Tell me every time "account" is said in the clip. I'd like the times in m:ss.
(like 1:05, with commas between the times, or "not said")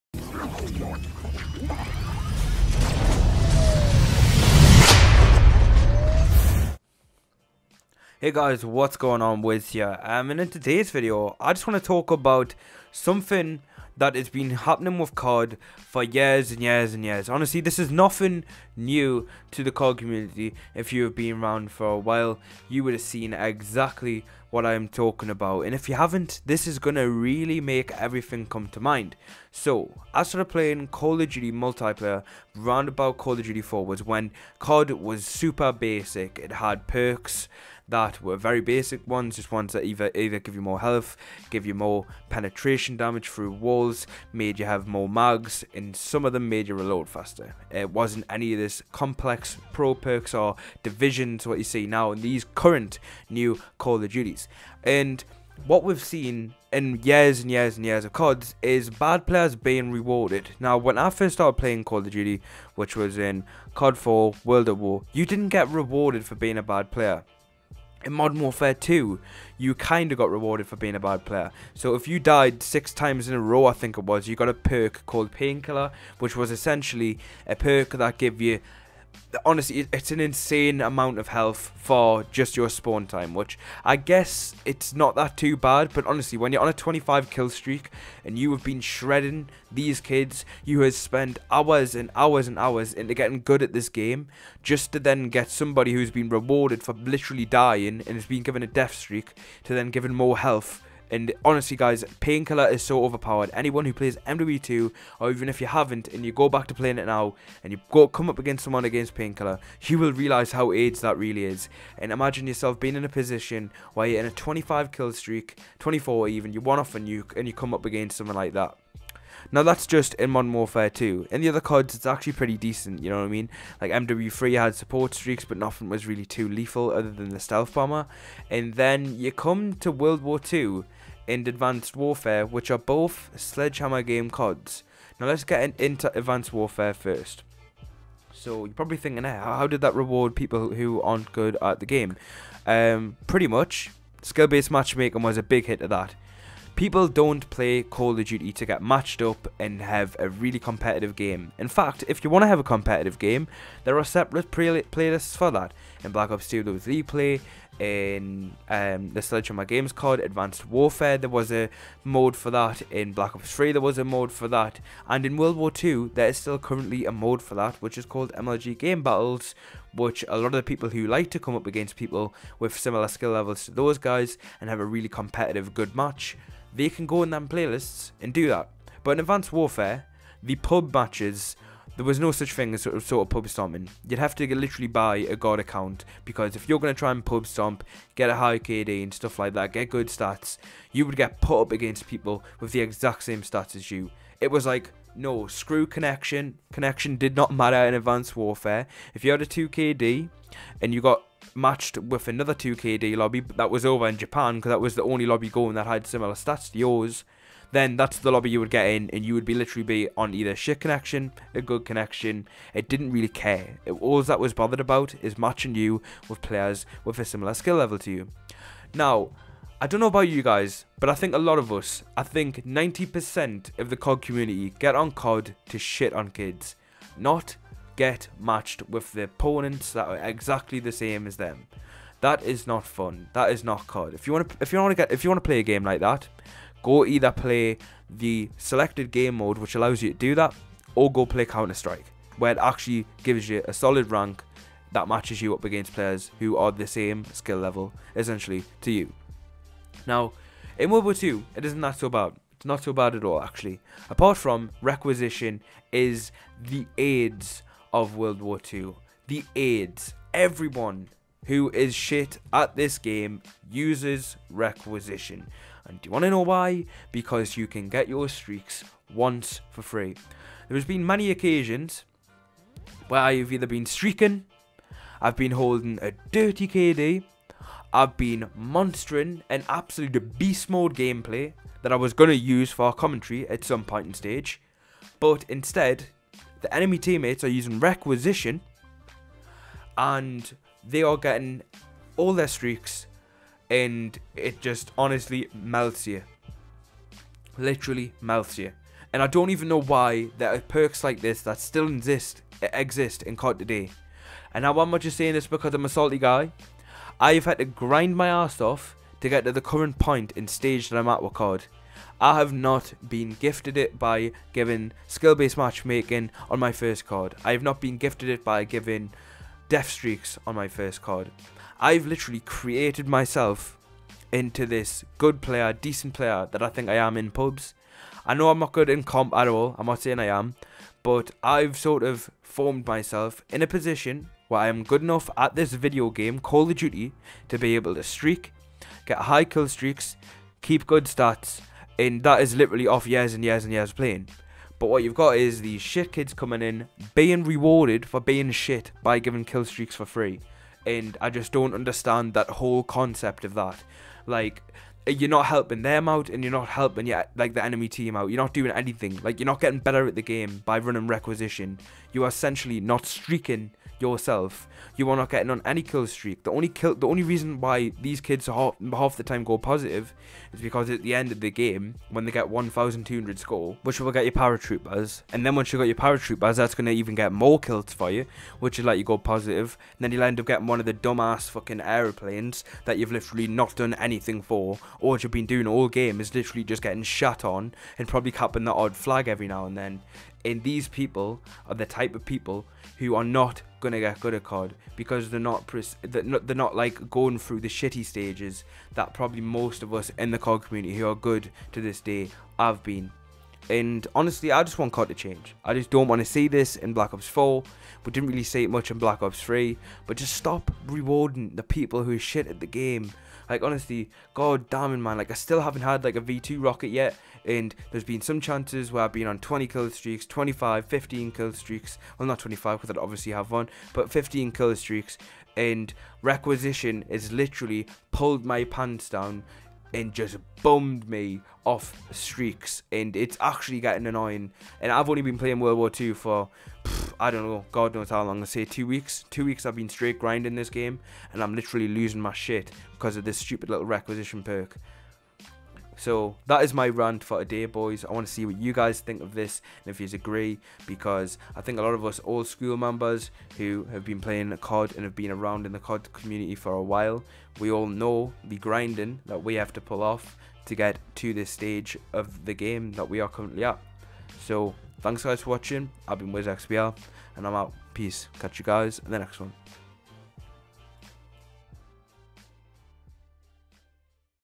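3:05.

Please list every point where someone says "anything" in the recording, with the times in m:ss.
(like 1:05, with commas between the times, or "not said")
5:58, 6:23.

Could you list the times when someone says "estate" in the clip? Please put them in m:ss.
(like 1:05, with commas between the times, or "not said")
not said.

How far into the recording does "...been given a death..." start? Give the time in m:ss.
1:38.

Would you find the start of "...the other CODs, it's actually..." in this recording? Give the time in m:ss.
2:01.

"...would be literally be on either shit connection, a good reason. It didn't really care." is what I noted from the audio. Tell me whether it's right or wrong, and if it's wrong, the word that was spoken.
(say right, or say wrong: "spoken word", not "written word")
wrong: "connection", not "reason".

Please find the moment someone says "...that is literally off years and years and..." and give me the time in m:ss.
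5:42.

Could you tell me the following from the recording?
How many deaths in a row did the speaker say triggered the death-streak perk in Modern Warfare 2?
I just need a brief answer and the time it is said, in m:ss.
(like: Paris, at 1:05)
6, at 1:12.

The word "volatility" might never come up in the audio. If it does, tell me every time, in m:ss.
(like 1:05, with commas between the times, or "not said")
not said.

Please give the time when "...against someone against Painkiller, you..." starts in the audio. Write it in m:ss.
1:48.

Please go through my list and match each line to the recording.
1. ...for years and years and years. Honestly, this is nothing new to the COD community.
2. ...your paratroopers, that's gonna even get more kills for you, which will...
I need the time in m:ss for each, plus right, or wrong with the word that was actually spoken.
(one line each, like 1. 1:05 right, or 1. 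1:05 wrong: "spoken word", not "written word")
1. 0:15 right
2. 6:15 right.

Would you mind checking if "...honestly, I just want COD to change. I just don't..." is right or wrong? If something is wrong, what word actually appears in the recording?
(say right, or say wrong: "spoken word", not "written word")
right.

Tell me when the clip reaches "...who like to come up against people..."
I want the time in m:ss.
2:50.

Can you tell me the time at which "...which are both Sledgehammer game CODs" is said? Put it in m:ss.
2:12.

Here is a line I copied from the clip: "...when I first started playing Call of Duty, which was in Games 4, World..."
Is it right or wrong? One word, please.
wrong.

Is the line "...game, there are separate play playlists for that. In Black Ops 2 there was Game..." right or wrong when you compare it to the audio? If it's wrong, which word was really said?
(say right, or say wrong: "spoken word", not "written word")
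wrong: "League", not "Game".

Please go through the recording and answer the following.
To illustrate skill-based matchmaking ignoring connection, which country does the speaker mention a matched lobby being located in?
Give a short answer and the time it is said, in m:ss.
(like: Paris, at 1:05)
Japan, at 3:24.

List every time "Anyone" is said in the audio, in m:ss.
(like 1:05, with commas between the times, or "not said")
1:43.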